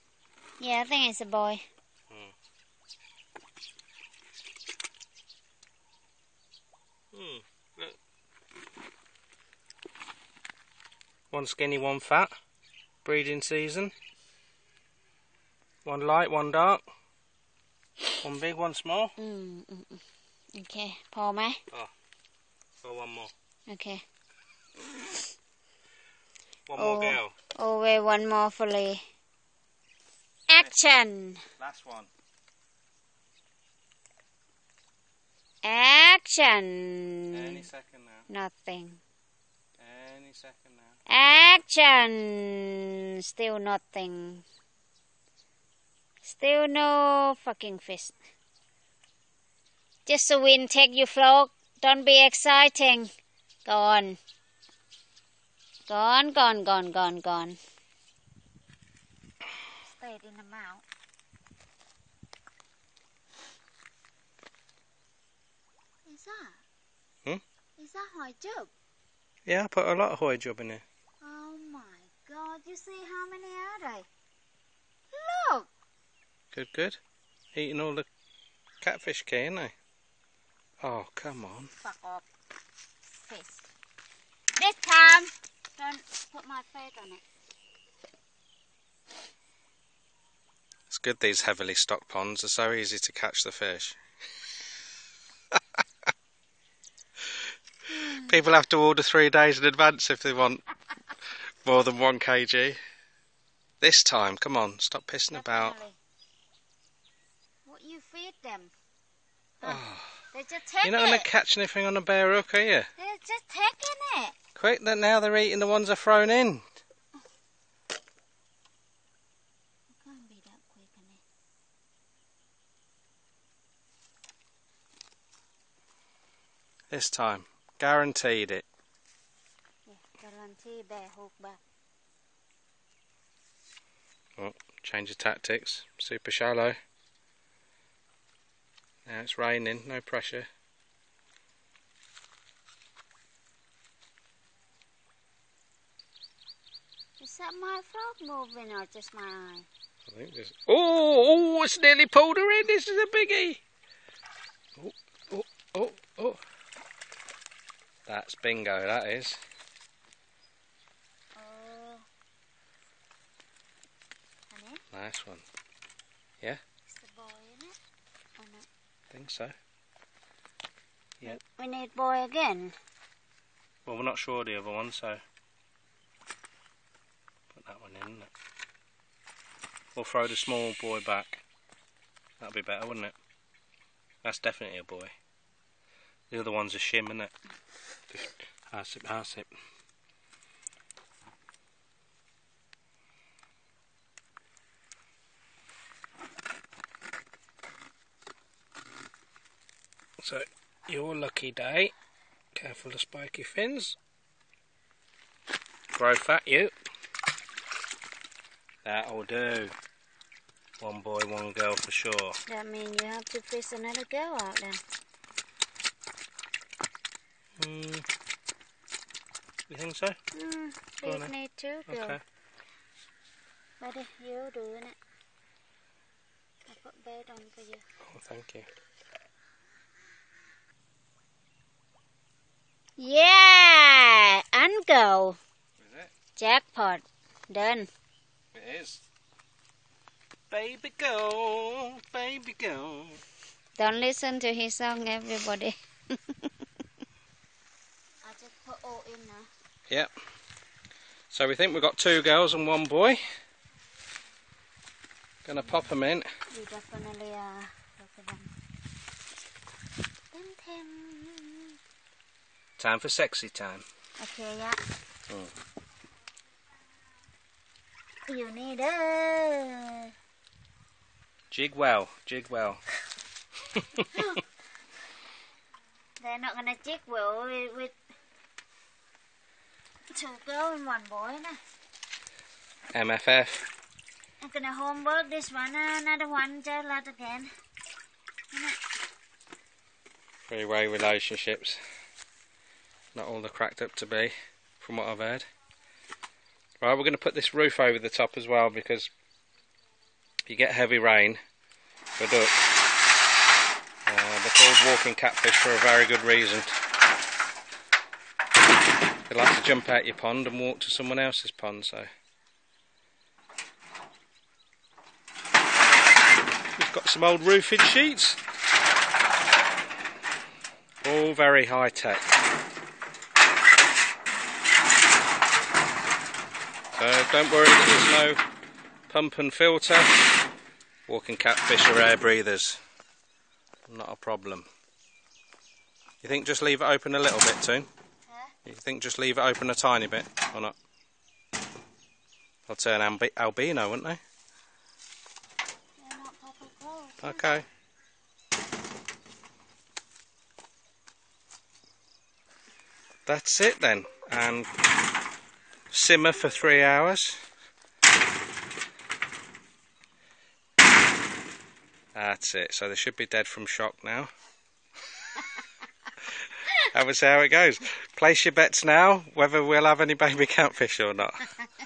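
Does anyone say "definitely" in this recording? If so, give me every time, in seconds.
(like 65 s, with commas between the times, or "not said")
105 s, 184 s, 256 s.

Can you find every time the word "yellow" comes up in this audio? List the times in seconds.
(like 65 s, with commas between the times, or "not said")
not said.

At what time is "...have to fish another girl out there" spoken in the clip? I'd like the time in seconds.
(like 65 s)
213 s.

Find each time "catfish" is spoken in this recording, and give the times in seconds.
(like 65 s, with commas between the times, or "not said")
78 s, 305 s, 331 s, 370 s.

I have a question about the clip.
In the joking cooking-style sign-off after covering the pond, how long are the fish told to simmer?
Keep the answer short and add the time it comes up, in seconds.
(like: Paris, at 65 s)
3 hours, at 356 s.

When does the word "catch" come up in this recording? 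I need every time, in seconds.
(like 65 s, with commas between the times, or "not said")
93 s, 111 s.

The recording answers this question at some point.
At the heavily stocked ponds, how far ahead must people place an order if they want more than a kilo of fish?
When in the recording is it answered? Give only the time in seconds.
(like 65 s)
99 s.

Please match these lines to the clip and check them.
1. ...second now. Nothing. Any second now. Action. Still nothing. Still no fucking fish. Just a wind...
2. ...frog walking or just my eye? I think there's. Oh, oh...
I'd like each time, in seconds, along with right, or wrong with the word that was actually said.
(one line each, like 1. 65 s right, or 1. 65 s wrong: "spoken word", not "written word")
1. 37 s right
2. 147 s wrong: "moving", not "walking".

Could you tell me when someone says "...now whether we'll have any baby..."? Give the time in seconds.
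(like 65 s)
368 s.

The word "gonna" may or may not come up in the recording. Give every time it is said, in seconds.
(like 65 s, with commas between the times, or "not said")
255 s, 284 s.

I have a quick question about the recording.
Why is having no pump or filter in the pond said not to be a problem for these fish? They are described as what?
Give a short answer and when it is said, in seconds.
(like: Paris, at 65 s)
Air breathers, at 331 s.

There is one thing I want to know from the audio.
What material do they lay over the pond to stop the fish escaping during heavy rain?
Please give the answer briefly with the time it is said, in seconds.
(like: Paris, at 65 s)
Old roofing sheets, at 317 s.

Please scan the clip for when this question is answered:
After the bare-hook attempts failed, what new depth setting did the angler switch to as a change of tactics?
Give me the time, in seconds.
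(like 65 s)
135 s.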